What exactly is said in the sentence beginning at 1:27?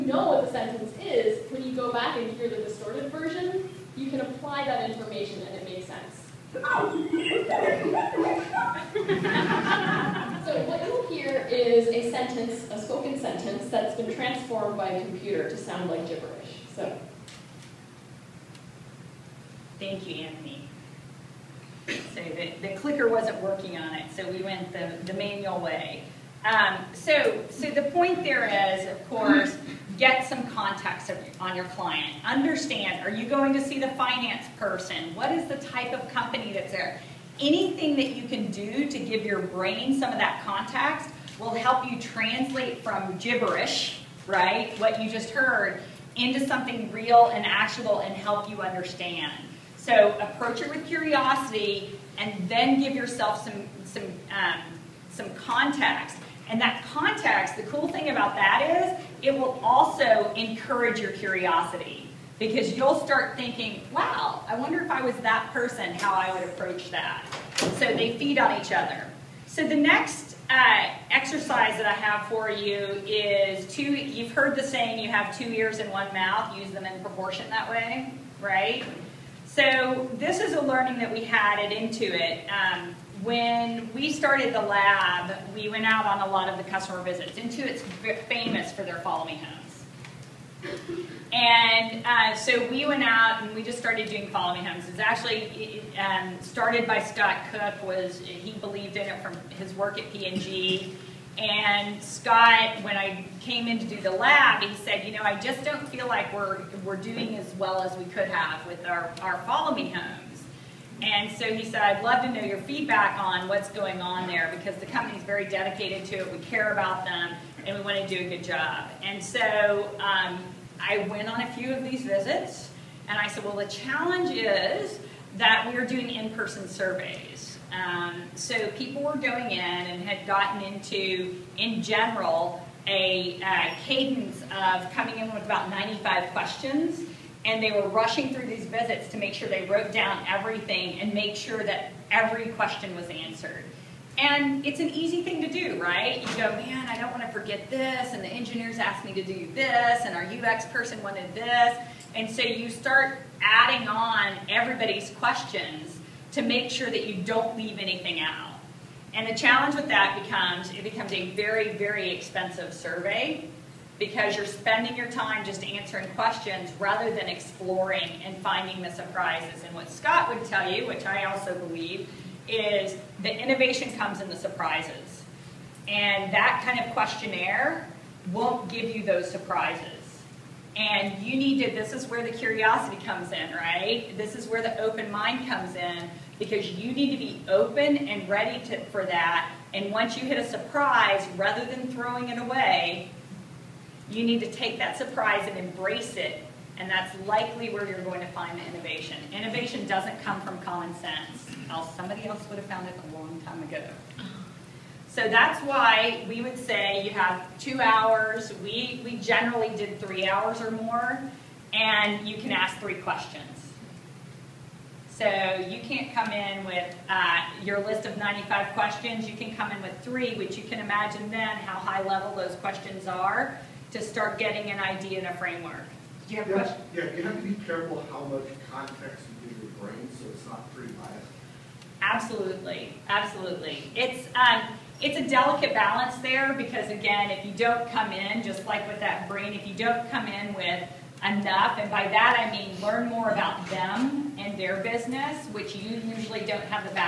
Intuit's famous for their follow me homes.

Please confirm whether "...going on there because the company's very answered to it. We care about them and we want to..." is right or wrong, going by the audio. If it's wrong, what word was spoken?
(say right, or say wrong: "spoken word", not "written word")
wrong: "dedicated", not "answered".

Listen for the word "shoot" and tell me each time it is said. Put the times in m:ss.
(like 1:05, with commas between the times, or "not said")
not said.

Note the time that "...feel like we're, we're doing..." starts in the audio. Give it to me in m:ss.
1:45.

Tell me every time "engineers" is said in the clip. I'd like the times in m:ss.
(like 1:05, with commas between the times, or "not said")
2:28.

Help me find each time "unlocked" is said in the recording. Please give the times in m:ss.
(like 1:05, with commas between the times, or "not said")
not said.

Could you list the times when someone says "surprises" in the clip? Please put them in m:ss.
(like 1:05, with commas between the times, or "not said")
2:48, 2:54, 2:59, 3:10, 3:14.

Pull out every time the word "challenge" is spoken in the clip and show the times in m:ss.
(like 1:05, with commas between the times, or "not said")
2:03, 2:39.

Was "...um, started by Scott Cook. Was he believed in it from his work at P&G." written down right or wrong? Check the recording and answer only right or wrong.
right.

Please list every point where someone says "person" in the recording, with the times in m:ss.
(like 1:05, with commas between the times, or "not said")
0:34, 1:05, 2:06, 2:30.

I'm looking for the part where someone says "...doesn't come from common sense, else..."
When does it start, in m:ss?
3:19.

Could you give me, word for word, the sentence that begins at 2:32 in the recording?
And so you start adding on everybody's questions to make sure that you don't leave anything out.